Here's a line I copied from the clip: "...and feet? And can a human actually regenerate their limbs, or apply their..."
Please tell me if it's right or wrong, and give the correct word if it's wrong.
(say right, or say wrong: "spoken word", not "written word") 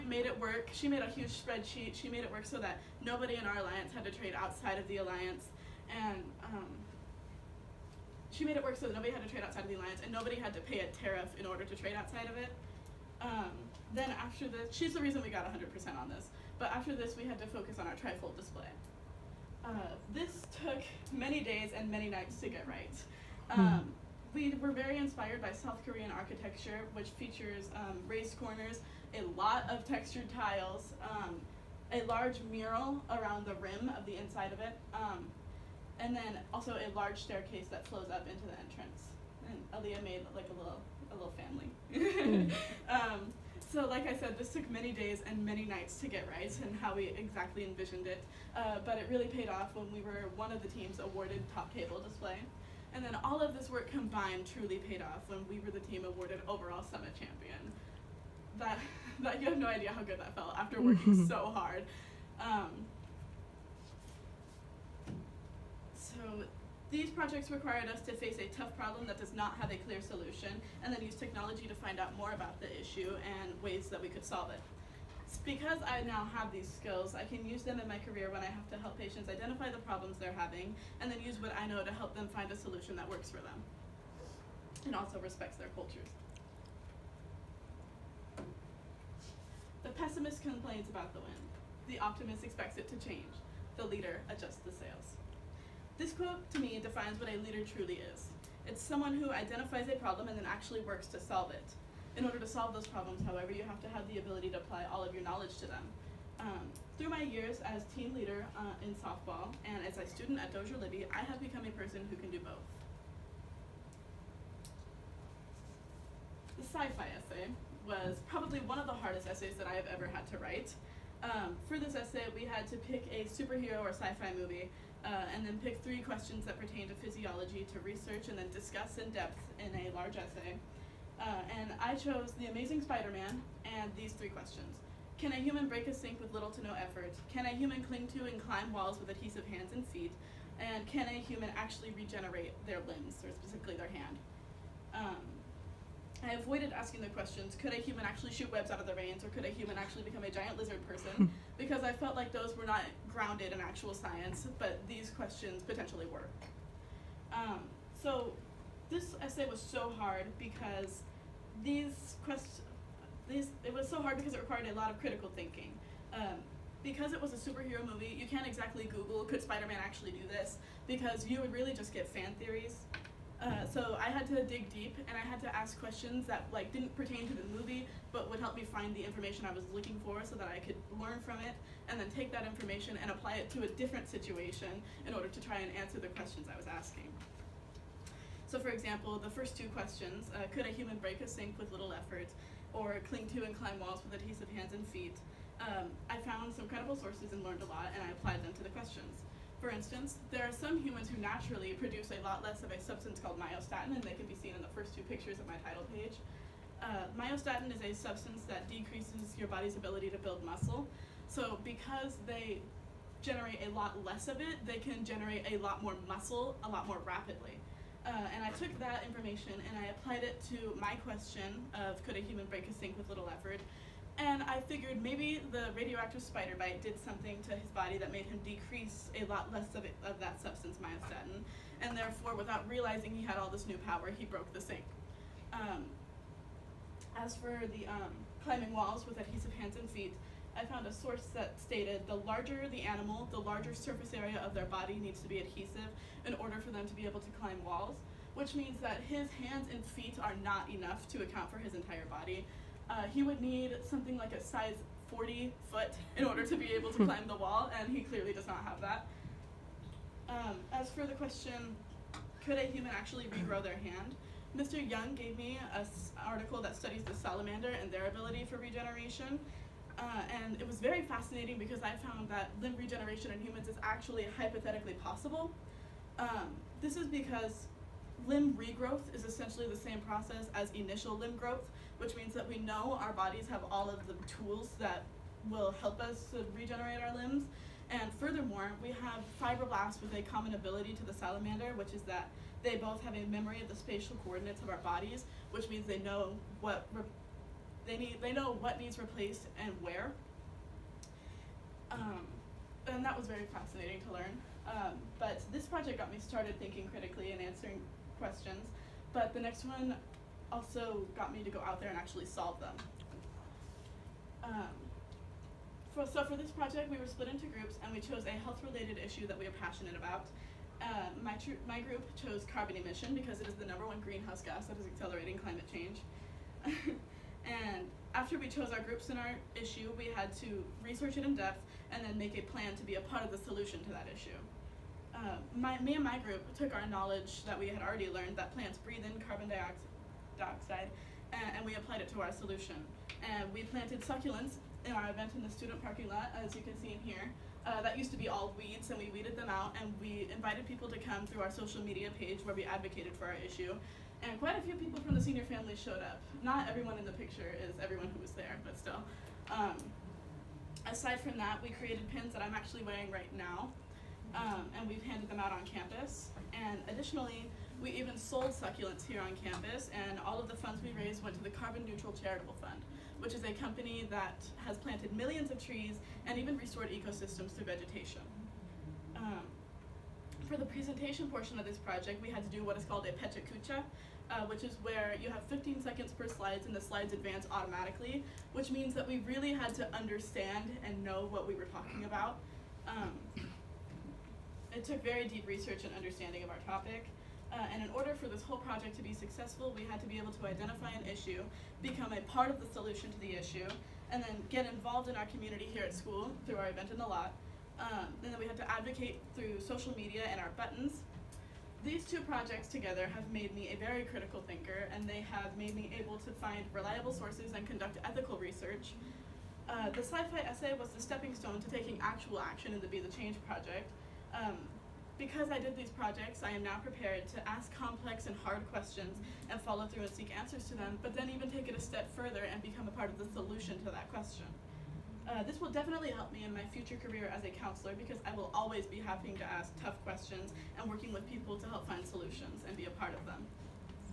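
wrong: "specifically", not "apply".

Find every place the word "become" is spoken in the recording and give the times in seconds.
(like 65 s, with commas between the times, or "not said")
111 s, 150 s, 401 s, 432 s.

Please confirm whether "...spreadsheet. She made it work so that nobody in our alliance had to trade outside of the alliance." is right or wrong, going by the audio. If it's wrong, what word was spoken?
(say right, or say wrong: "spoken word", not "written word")
right.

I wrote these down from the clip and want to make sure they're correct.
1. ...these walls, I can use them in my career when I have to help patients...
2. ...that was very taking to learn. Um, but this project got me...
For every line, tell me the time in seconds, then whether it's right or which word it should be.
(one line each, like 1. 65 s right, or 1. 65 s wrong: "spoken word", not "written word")
1. 76 s wrong: "skills", not "walls"
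2. 303 s wrong: "fascinating", not "taking".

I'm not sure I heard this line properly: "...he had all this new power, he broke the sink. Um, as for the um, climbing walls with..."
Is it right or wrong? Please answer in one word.
right.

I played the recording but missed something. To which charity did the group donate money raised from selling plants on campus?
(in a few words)
Carbon Neutral Charitable Fund.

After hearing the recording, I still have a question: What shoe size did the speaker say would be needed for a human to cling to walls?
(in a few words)
Size 40.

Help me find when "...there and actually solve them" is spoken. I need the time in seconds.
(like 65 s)
311 s.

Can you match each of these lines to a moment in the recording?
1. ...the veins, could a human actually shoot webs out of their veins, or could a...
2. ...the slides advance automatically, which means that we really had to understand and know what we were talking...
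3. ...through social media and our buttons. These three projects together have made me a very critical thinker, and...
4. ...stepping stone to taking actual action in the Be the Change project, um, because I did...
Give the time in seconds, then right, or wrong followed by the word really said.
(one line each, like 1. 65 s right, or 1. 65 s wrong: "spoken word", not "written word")
1. 147 s wrong: "questions", not "veins"
2. 386 s right
3. 409 s wrong: "two", not "three"
4. 421 s right.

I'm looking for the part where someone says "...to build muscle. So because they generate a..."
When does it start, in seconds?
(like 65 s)
210 s.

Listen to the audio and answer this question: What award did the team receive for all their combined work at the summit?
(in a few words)
Overall summit champion.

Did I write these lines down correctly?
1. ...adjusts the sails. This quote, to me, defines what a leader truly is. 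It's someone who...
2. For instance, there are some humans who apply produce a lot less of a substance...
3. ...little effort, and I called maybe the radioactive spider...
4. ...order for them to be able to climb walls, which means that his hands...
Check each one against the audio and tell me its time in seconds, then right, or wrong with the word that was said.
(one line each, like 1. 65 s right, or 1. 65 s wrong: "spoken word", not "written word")
1. 94 s right
2. 199 s wrong: "naturally", not "apply"
3. 223 s wrong: "figured", not "called"
4. 246 s right.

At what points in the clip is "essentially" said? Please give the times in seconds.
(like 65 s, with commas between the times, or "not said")
279 s.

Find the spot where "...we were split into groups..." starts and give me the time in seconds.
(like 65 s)
316 s.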